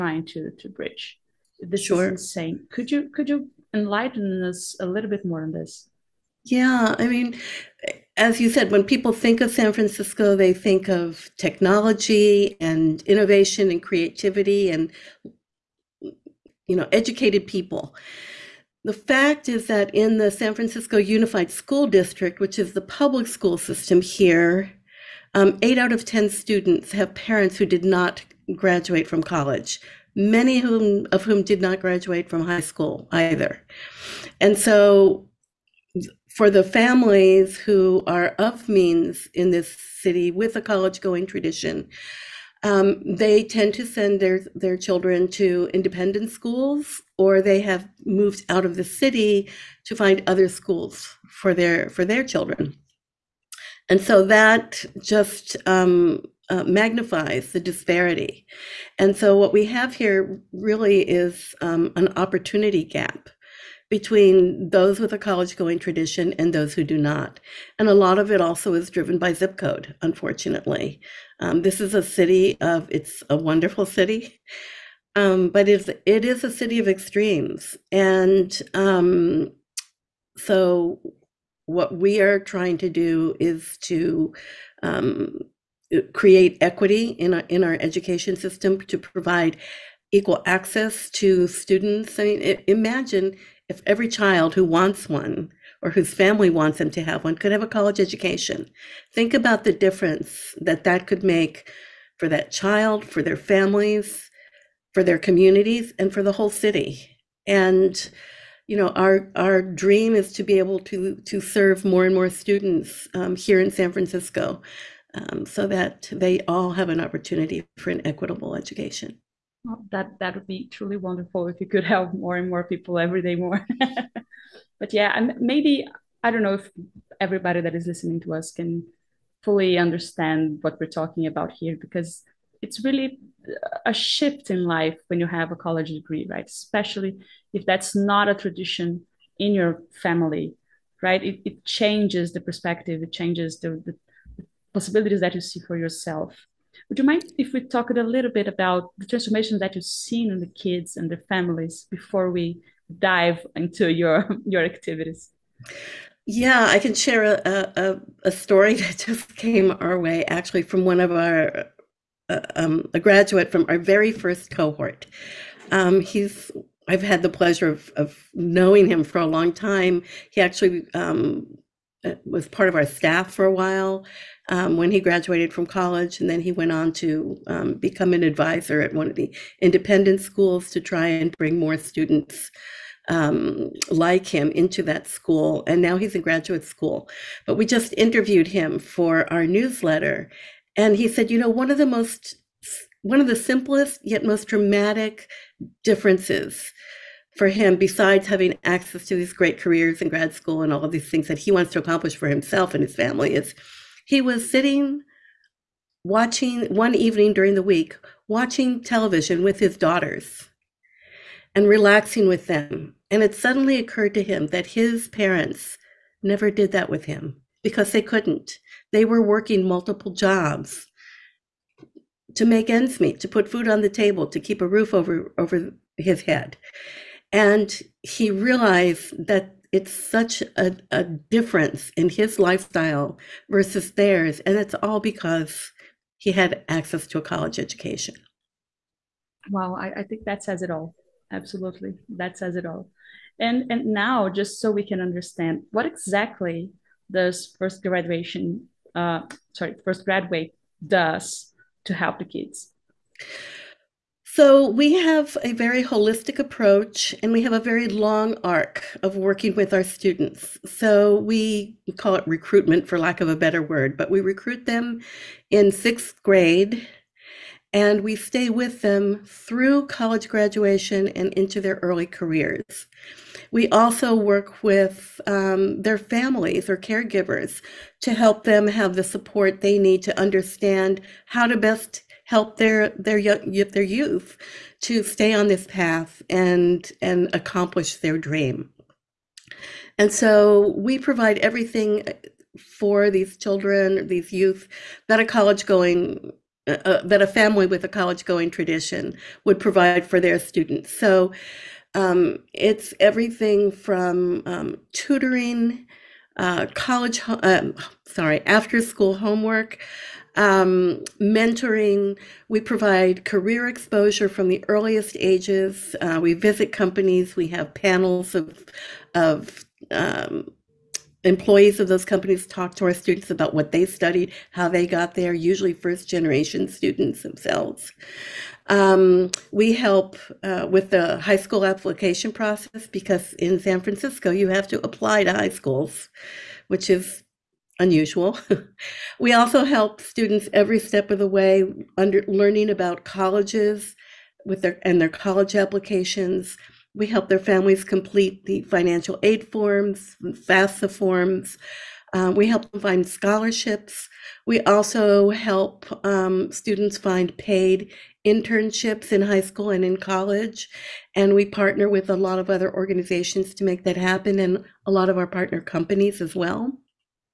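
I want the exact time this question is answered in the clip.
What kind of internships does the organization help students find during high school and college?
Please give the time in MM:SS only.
05:57.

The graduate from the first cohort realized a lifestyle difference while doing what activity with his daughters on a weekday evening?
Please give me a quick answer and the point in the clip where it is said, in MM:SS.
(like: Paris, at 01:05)
watching television, at 03:28.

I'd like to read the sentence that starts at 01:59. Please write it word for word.
Well, that that would be truly wonderful if you could help more and more people every day more.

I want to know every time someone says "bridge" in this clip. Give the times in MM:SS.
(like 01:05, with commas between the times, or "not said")
00:00.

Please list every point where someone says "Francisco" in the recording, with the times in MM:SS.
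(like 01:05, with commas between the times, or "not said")
00:09, 00:20, 01:53, 05:33.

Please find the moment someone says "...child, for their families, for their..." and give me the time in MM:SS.
01:42.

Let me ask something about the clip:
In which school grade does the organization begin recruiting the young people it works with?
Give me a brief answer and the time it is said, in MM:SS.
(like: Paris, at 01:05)
sixth grade, at 04:25.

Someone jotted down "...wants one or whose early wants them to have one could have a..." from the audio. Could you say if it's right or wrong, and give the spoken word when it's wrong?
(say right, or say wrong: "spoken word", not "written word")
wrong: "family", not "early".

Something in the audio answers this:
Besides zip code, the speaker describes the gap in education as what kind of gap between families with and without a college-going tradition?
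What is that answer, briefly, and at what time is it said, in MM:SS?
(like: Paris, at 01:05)
opportunity gap, at 01:02.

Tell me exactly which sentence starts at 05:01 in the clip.
So um, it's everything from um, tutoring, uh, college, um, sorry, after school homework, um, mentoring.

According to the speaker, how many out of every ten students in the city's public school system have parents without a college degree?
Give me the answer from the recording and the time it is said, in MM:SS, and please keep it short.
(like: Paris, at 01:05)
8, at 00:25.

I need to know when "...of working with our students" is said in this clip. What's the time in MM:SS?
04:19.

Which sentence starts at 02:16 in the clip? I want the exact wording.
Especially if that's not a tradition in your family, right?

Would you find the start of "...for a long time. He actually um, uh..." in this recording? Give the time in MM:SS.
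02:49.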